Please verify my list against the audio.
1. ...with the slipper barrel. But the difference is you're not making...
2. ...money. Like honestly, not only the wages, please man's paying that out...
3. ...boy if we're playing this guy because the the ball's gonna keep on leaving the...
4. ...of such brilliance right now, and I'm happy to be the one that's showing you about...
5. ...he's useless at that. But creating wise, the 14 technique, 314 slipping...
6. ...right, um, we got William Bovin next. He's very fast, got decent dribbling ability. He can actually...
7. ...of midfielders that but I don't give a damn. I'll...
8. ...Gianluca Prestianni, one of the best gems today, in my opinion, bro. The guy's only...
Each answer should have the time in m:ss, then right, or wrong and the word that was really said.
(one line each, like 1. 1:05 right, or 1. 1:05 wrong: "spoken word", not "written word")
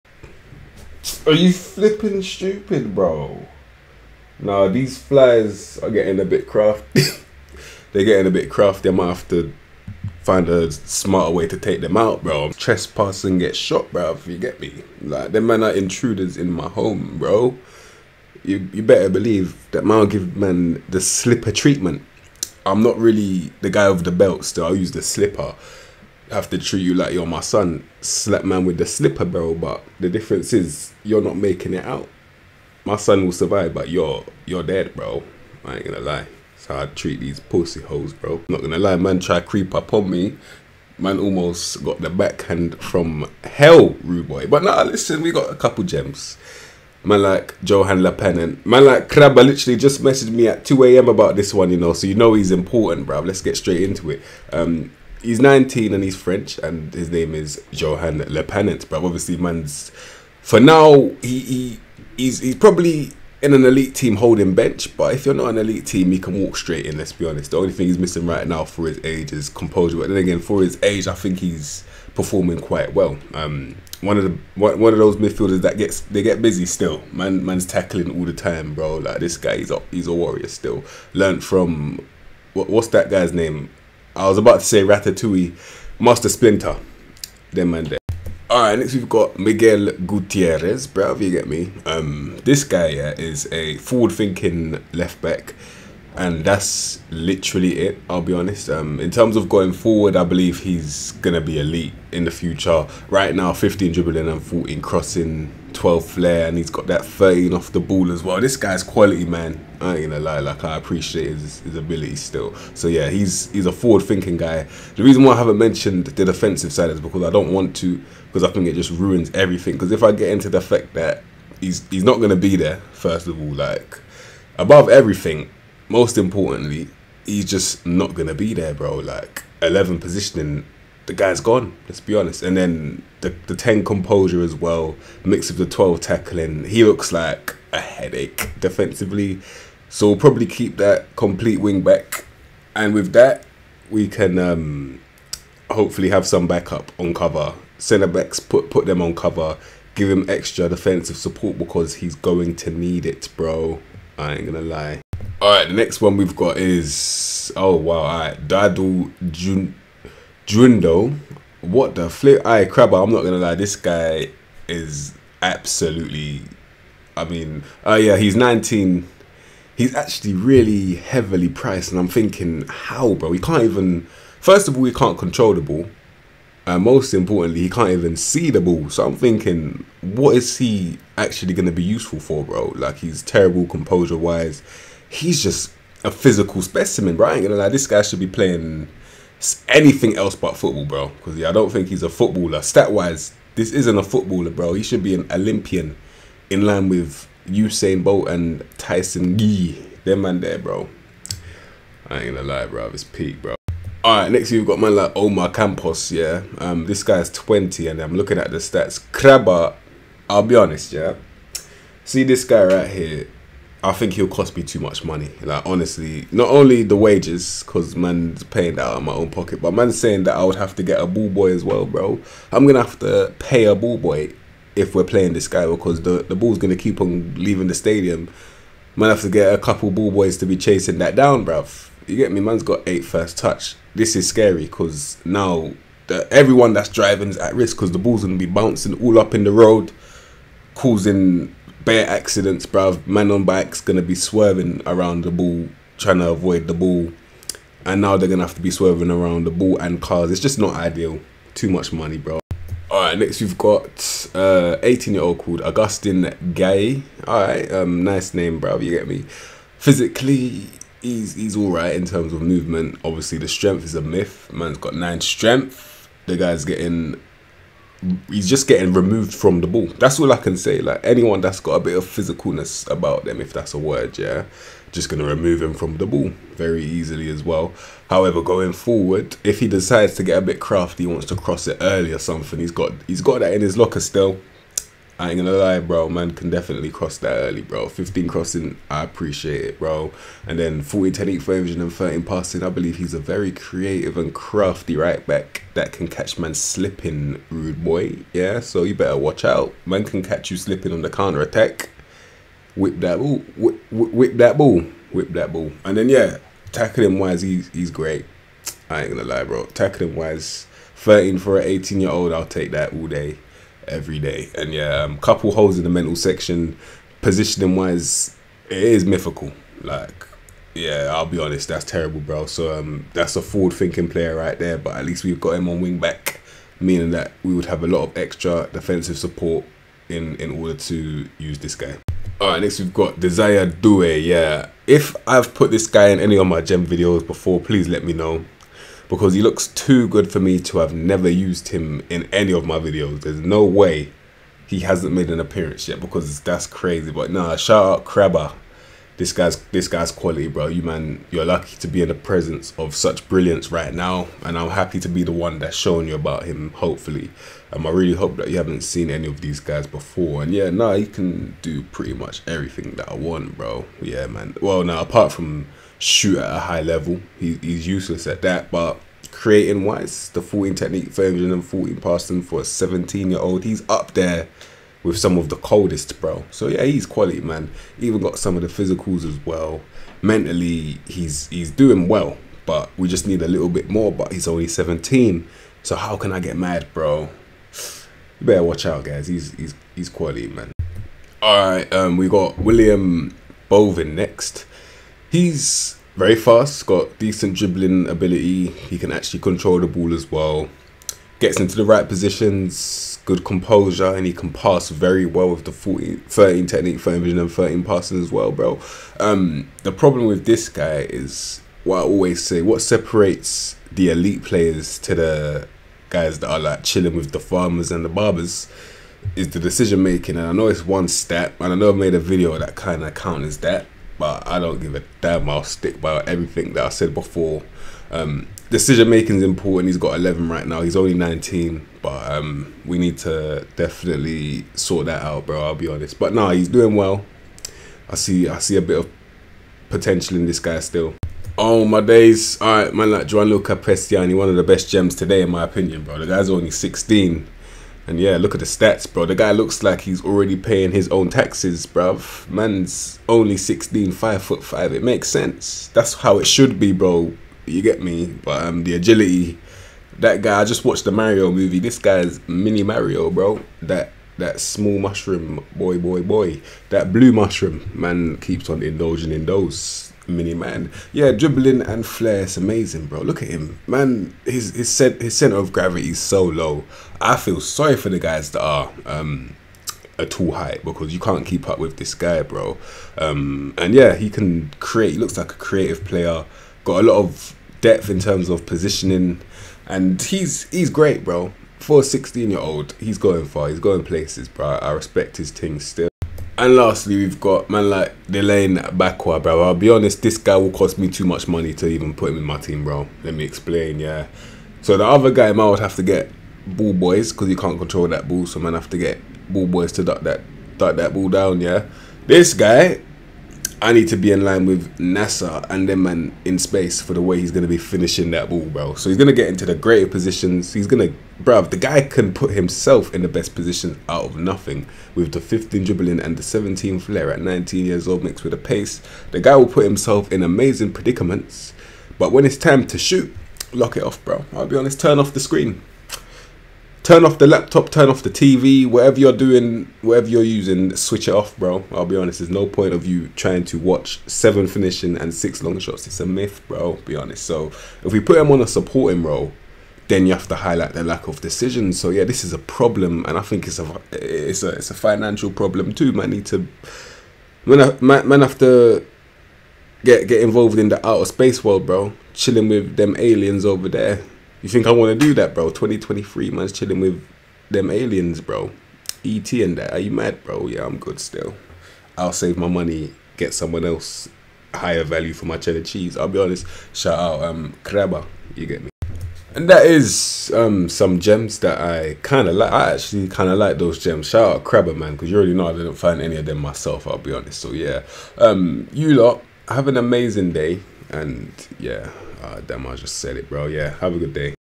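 1. 0:28 right
2. 3:35 wrong: "cause", not "please"
3. 3:43 right
4. 5:52 right
5. 6:07 wrong: "passing", not "slipping"
6. 6:31 right
7. 7:03 wrong: "counters", not "midfielders"
8. 7:23 right.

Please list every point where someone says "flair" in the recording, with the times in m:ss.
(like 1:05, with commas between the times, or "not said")
1:46, 7:52, 8:46.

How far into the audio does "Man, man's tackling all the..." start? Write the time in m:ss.
1:17.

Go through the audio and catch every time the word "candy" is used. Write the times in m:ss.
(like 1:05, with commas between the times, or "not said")
not said.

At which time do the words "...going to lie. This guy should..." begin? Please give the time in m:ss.
3:07.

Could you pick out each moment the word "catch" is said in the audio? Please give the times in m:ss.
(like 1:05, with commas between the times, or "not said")
4:56, 5:00.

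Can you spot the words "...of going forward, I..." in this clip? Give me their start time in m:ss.
1:39.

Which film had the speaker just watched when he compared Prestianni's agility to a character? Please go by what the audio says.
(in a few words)
the Mario movie.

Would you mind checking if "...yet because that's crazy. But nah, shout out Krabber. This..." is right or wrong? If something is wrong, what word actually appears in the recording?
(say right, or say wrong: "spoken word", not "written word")
right.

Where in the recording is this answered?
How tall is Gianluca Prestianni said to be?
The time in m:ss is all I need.
7:34.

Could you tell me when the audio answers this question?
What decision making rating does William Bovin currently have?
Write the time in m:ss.
7:09.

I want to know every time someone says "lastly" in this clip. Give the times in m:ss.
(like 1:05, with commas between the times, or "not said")
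8:16.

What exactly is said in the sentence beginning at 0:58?
But obviously, man's for now he, he he's he's probably in an elite team holding bench.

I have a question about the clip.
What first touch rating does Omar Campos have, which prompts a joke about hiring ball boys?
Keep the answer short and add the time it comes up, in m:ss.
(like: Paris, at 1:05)
8, at 3:52.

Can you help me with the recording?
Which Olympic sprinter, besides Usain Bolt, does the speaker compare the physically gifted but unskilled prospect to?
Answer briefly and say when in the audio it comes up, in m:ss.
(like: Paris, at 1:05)
Tyson Gay, at 3:18.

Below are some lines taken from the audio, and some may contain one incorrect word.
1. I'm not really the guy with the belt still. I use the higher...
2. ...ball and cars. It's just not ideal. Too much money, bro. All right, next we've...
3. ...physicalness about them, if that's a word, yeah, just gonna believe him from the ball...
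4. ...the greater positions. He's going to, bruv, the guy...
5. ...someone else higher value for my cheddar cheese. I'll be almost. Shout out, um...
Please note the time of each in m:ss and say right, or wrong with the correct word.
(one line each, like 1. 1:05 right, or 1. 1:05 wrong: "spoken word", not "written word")
1. 0:22 wrong: "slipper", not "higher"
2. 4:09 right
3. 4:32 wrong: "remove", not "believe"
4. 8:39 right
5. 9:33 wrong: "honest", not "almost".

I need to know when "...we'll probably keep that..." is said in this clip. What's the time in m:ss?
2:20.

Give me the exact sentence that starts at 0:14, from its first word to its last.
Like, them man are intruders in my home, bro.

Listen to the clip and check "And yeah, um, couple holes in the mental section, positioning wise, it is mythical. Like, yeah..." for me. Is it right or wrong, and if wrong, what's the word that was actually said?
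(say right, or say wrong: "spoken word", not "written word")
right.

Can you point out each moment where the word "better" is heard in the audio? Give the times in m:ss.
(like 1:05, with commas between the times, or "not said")
0:18, 4:58, 6:28.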